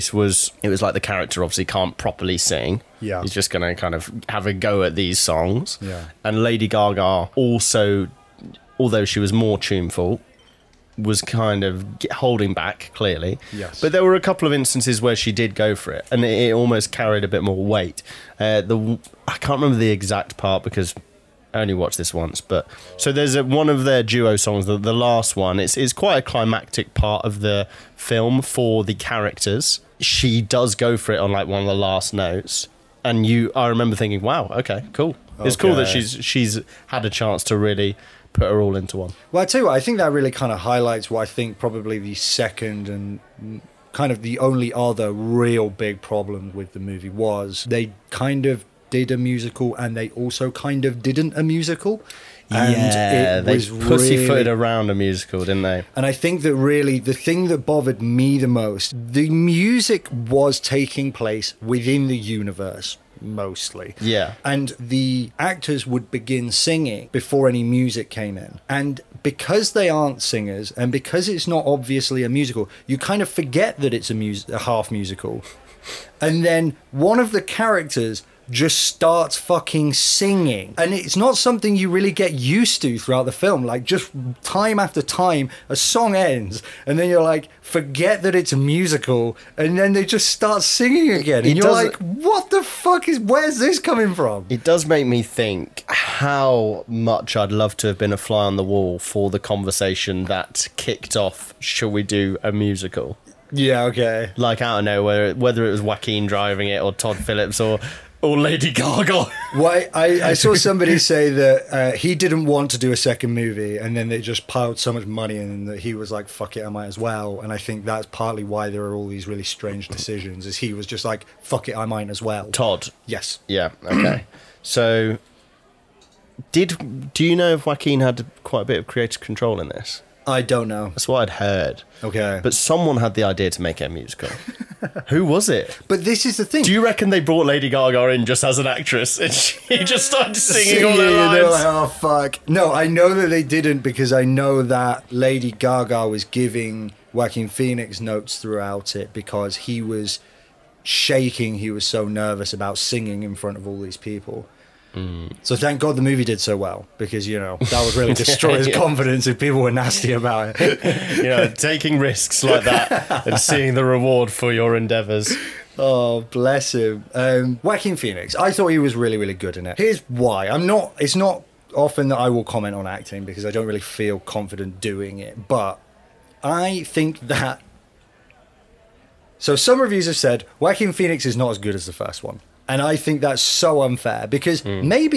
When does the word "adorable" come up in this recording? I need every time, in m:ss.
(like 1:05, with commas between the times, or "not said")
not said.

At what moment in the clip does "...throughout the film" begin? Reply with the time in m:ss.
1:22.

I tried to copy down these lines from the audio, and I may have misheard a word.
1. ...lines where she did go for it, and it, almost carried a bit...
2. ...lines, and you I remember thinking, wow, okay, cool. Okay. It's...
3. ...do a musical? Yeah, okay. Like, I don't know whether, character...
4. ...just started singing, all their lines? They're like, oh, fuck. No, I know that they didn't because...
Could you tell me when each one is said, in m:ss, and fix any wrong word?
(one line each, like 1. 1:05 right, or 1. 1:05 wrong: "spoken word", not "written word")
1. 0:14 wrong: "instances", not "lines"
2. 0:32 wrong: "notes", not "lines"
3. 1:42 wrong: "whether", not "character"
4. 2:19 right.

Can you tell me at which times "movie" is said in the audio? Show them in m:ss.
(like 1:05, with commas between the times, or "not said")
0:46, 1:53, 2:36.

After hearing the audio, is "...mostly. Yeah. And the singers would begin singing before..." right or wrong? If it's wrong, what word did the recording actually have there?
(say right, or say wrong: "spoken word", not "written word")
wrong: "actors", not "singers".